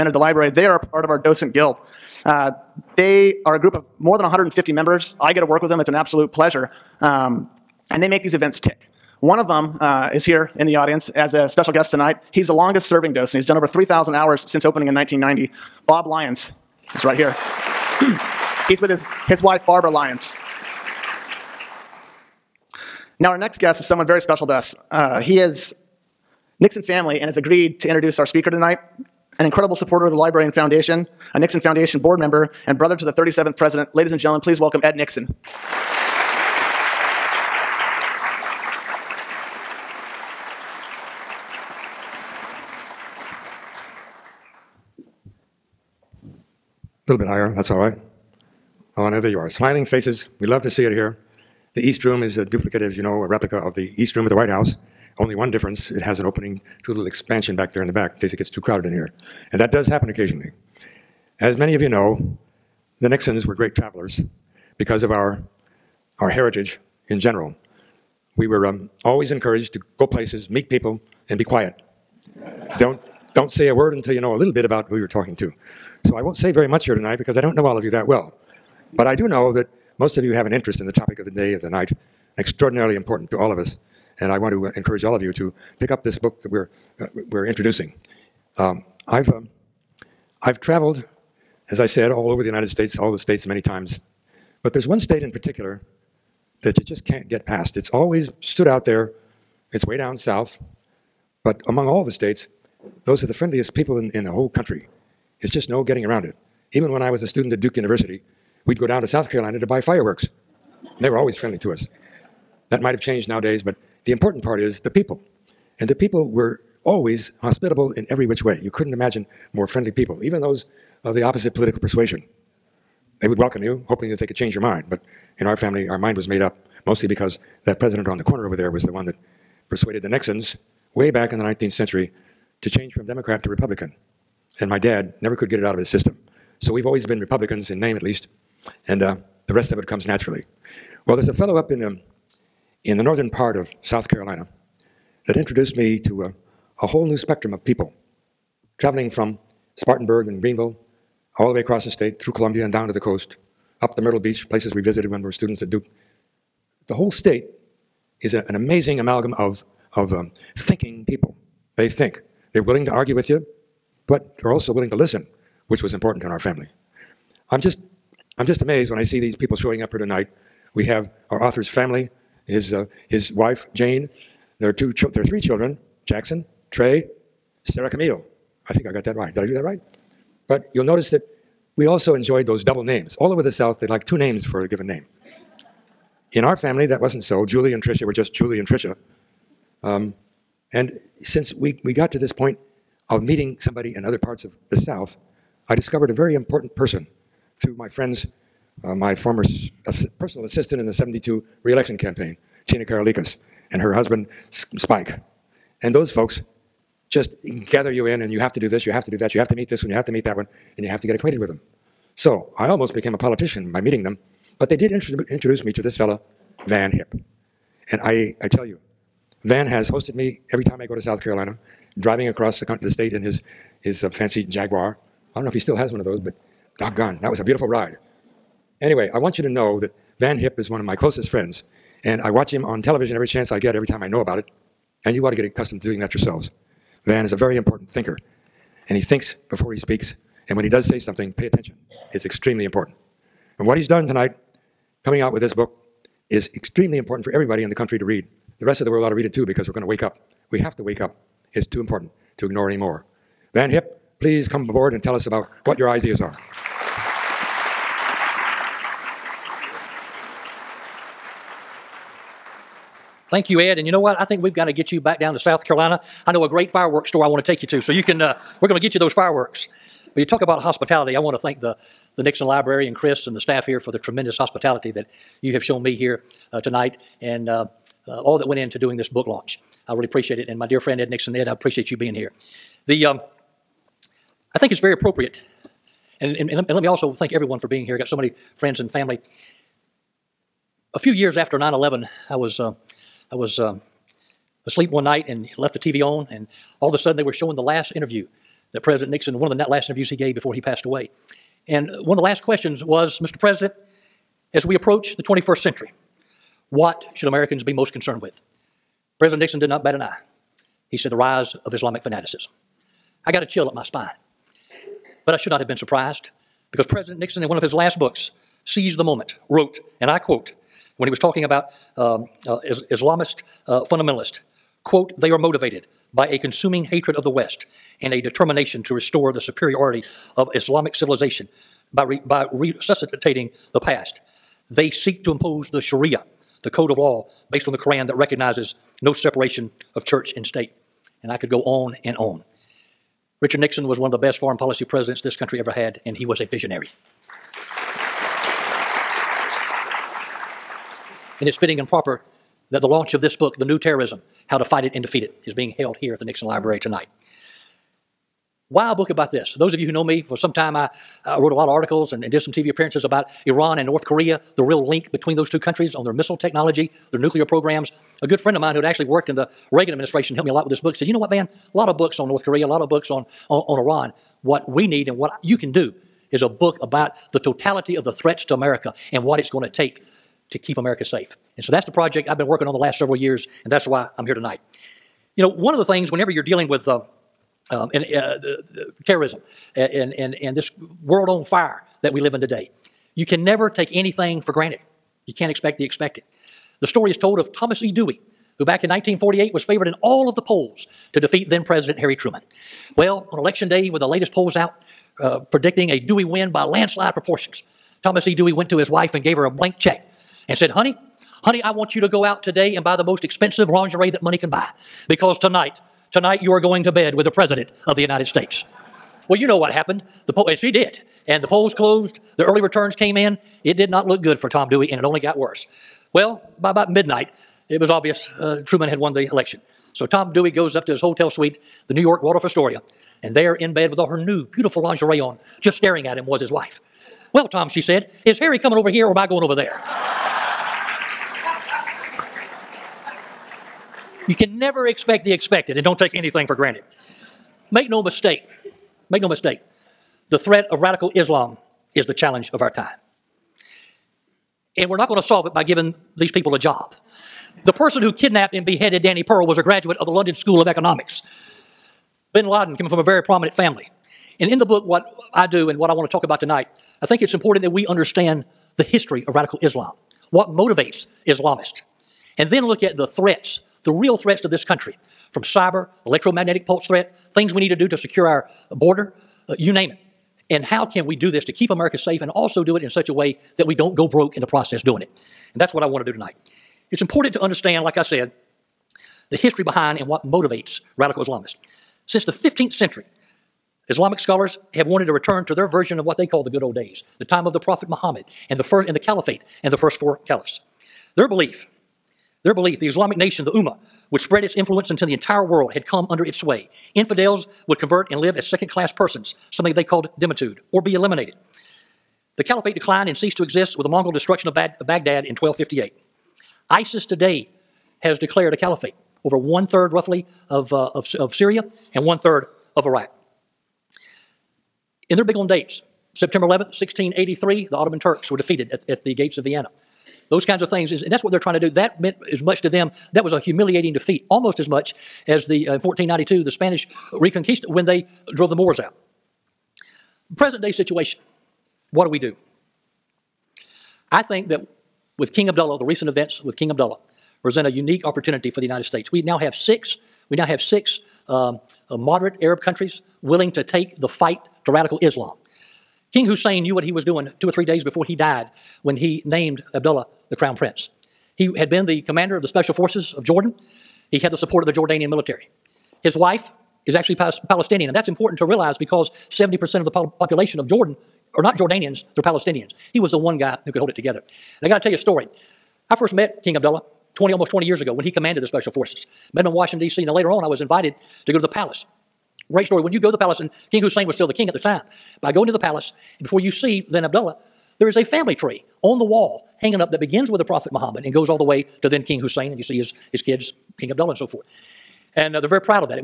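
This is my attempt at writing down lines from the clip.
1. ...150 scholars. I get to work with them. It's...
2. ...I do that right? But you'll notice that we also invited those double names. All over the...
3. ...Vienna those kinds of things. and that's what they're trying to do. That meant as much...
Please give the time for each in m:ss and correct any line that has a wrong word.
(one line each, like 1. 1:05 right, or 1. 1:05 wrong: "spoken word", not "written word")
1. 0:04 wrong: "members", not "scholars"
2. 2:59 wrong: "enjoyed", not "invited"
3. 8:49 right.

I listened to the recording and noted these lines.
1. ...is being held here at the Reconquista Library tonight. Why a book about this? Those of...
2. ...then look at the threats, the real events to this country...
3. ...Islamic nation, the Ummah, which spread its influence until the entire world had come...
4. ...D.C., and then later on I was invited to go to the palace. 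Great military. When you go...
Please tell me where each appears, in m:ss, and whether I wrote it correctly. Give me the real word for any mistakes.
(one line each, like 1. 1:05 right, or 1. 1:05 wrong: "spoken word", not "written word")
1. 5:55 wrong: "Nixon", not "Reconquista"
2. 7:52 wrong: "threats", not "events"
3. 8:22 right
4. 9:39 wrong: "story", not "military".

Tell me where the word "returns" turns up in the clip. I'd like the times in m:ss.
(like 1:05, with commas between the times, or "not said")
7:02, 8:15.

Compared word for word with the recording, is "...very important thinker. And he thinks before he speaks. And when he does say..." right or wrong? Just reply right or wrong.
right.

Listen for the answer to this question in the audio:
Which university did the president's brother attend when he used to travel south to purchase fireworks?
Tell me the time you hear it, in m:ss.
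1:47.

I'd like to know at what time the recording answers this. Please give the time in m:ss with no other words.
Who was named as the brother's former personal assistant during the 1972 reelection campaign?
3:22.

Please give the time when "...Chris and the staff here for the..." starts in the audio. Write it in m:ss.
4:32.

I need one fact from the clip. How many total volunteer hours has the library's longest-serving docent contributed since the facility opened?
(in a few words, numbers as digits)
over 3,000.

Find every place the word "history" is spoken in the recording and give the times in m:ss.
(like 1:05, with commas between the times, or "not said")
7:48, 8:09.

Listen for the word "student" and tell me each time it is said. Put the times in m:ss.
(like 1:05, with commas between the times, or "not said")
1:47, 2:35.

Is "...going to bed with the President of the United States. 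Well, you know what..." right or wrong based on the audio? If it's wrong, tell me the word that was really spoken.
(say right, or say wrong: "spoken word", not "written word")
right.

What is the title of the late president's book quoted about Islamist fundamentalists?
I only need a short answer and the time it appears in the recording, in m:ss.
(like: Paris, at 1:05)
Seize the Moment, at 5:18.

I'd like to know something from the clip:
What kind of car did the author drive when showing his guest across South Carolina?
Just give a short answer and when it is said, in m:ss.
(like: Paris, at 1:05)
Jaguar, at 3:44.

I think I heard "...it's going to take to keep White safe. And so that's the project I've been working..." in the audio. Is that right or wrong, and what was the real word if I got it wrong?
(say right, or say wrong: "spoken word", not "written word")
wrong: "America", not "White".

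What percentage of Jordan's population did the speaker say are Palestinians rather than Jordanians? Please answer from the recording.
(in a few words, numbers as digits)
70%.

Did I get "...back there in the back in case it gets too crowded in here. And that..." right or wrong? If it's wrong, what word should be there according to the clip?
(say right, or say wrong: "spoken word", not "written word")
right.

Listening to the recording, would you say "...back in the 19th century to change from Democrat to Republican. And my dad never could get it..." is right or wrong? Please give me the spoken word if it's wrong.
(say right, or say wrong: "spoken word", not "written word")
right.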